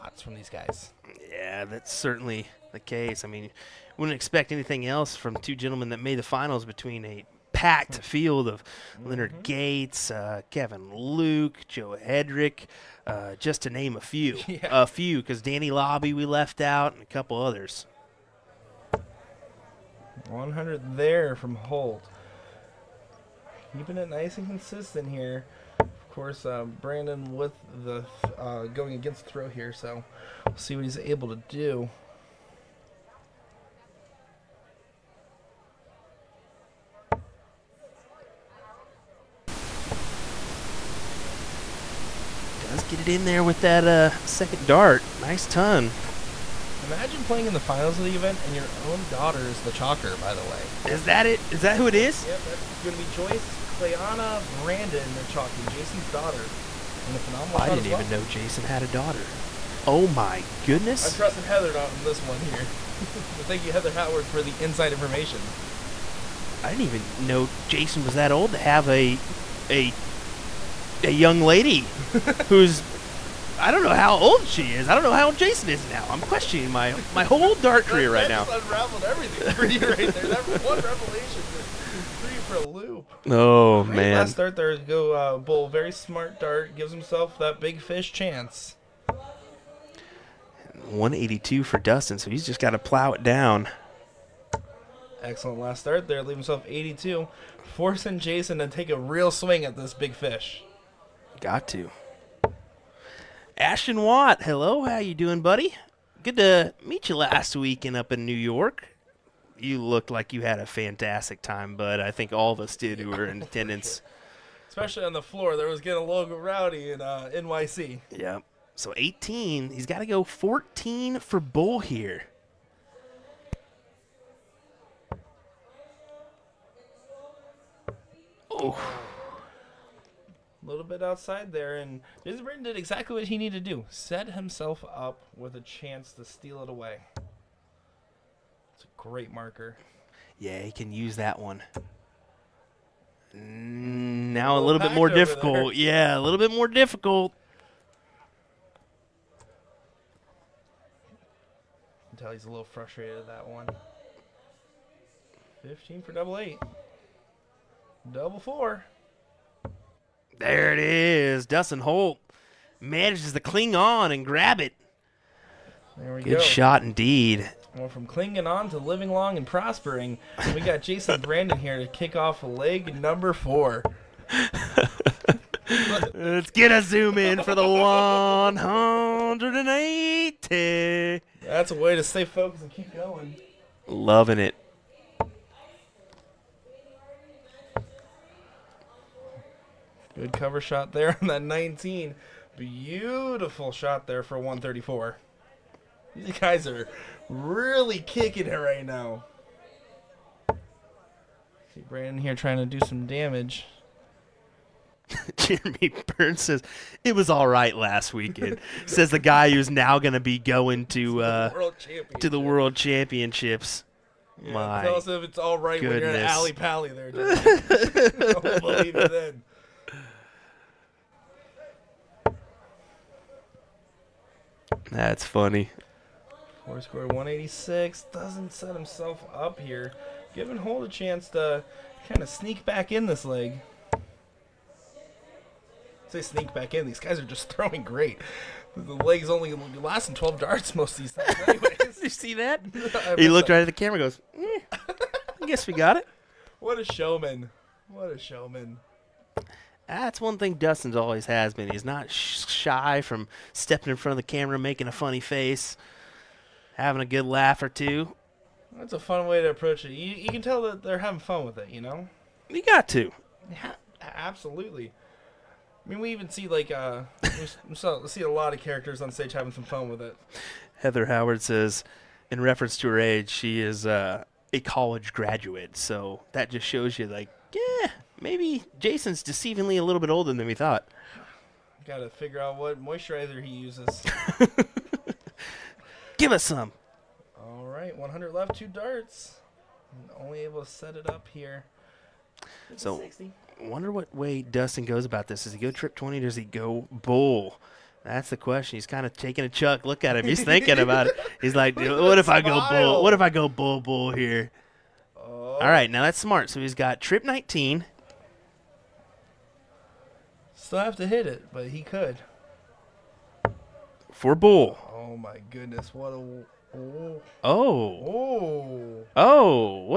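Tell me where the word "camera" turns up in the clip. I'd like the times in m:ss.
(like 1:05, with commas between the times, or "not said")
4:03, 4:14.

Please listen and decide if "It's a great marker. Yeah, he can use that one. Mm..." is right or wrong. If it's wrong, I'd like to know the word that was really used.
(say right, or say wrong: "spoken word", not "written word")
right.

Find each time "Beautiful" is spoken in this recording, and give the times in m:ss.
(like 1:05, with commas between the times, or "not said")
3:12.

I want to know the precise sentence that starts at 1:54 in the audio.
Especially on the floor, there was getting a little rowdy in uh, NYC.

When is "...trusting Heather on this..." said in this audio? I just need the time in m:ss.
1:01.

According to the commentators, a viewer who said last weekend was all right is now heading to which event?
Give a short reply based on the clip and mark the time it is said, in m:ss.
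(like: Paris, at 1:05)
World Championships, at 3:32.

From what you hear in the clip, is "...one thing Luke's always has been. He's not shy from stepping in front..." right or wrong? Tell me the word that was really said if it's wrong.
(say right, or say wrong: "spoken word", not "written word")
wrong: "Dustin", not "Luke".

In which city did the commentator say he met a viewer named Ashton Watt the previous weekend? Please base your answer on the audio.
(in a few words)
New York.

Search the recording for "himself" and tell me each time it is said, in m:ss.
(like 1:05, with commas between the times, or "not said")
1:26, 1:36, 2:14, 3:48.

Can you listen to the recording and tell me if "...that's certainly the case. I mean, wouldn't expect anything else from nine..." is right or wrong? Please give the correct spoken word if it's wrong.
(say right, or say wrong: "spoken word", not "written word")
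wrong: "two", not "nine".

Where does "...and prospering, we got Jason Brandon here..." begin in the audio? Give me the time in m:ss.
2:49.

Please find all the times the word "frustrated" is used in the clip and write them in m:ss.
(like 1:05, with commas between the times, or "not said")
2:32.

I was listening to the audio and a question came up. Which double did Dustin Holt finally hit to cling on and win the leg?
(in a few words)
Double four.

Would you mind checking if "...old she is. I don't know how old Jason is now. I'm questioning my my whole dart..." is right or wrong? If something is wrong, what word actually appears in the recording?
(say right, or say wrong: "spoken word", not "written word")
right.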